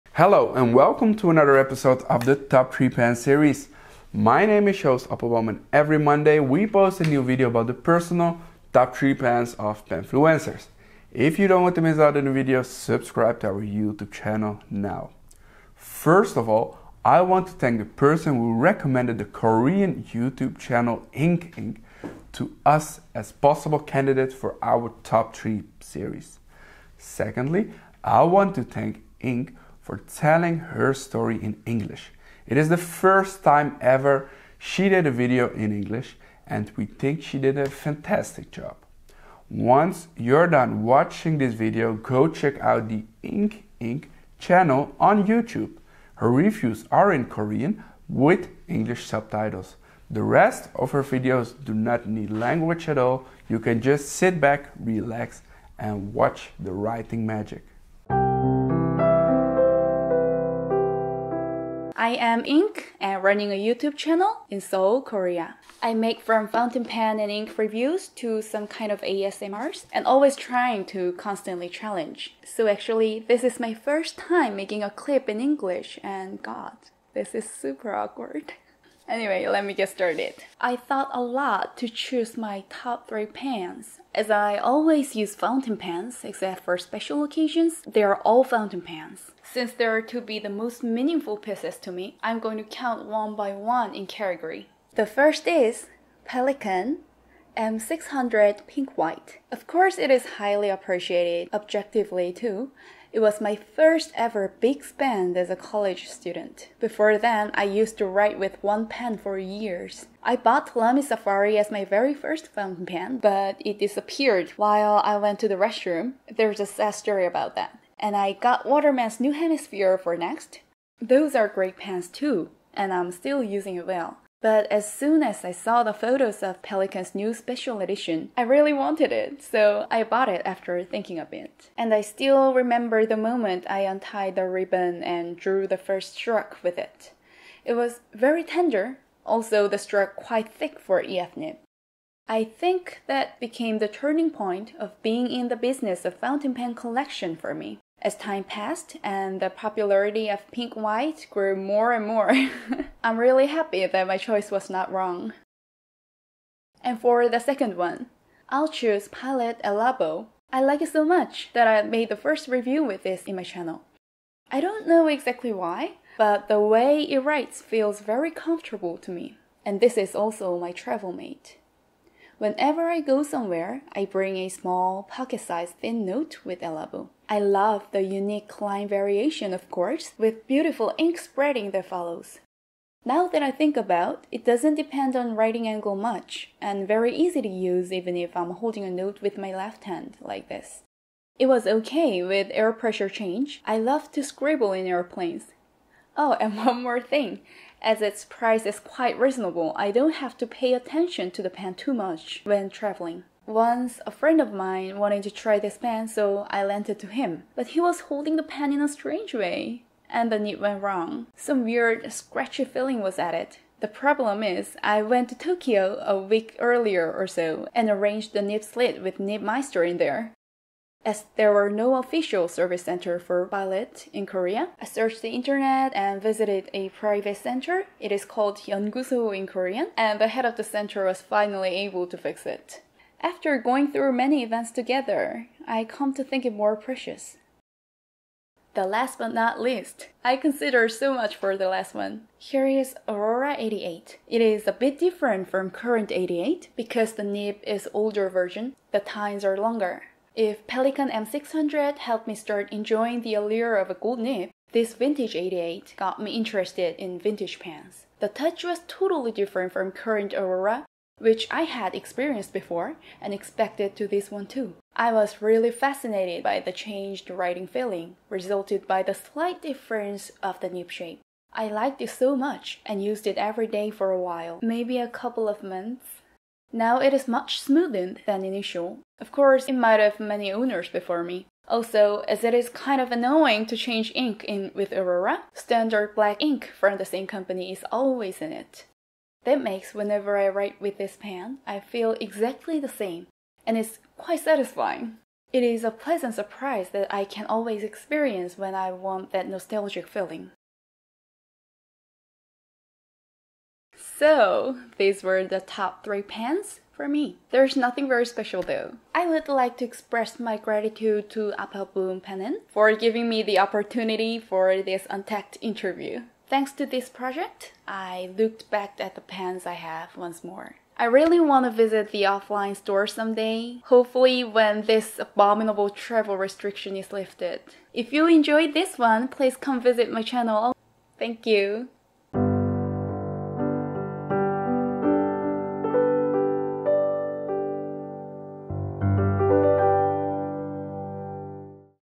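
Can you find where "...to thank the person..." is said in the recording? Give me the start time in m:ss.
0:17.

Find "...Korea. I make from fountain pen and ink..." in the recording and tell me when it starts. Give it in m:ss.
1:05.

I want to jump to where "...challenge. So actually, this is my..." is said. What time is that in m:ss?
1:11.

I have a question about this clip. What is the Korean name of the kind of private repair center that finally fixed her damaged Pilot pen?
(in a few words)
Yeonguso.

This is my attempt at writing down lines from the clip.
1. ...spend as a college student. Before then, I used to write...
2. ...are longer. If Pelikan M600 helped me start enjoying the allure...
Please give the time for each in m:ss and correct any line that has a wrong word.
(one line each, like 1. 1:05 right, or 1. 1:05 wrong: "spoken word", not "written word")
1. 1:44 right
2. 4:09 right.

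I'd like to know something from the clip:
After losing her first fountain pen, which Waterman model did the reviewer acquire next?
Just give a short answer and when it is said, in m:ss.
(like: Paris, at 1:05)
New Hemisphere, at 1:59.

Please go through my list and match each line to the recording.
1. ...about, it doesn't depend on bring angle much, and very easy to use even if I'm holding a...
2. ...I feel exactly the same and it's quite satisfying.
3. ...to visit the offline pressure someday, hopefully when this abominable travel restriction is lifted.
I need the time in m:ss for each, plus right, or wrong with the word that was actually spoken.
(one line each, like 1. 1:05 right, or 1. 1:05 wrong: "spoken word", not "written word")
1. 3:03 wrong: "writing", not "bring"
2. 4:51 right
3. 5:21 wrong: "store", not "pressure".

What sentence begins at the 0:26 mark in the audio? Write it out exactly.
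Secondly, I want to thank Ink for telling her story in English.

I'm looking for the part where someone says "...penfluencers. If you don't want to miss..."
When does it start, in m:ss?
0:09.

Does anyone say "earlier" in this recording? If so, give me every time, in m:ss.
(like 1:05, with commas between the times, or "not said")
3:36.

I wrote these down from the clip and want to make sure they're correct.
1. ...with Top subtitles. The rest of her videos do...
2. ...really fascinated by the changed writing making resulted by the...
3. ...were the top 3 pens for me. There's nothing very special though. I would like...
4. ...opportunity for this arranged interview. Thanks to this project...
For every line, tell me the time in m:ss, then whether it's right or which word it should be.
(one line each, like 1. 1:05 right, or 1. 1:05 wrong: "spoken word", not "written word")
1. 0:48 wrong: "English", not "Top"
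2. 4:25 wrong: "feeling", not "making"
3. 5:05 right
4. 5:13 wrong: "untacked", not "arranged".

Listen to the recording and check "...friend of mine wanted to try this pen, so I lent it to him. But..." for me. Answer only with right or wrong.
right.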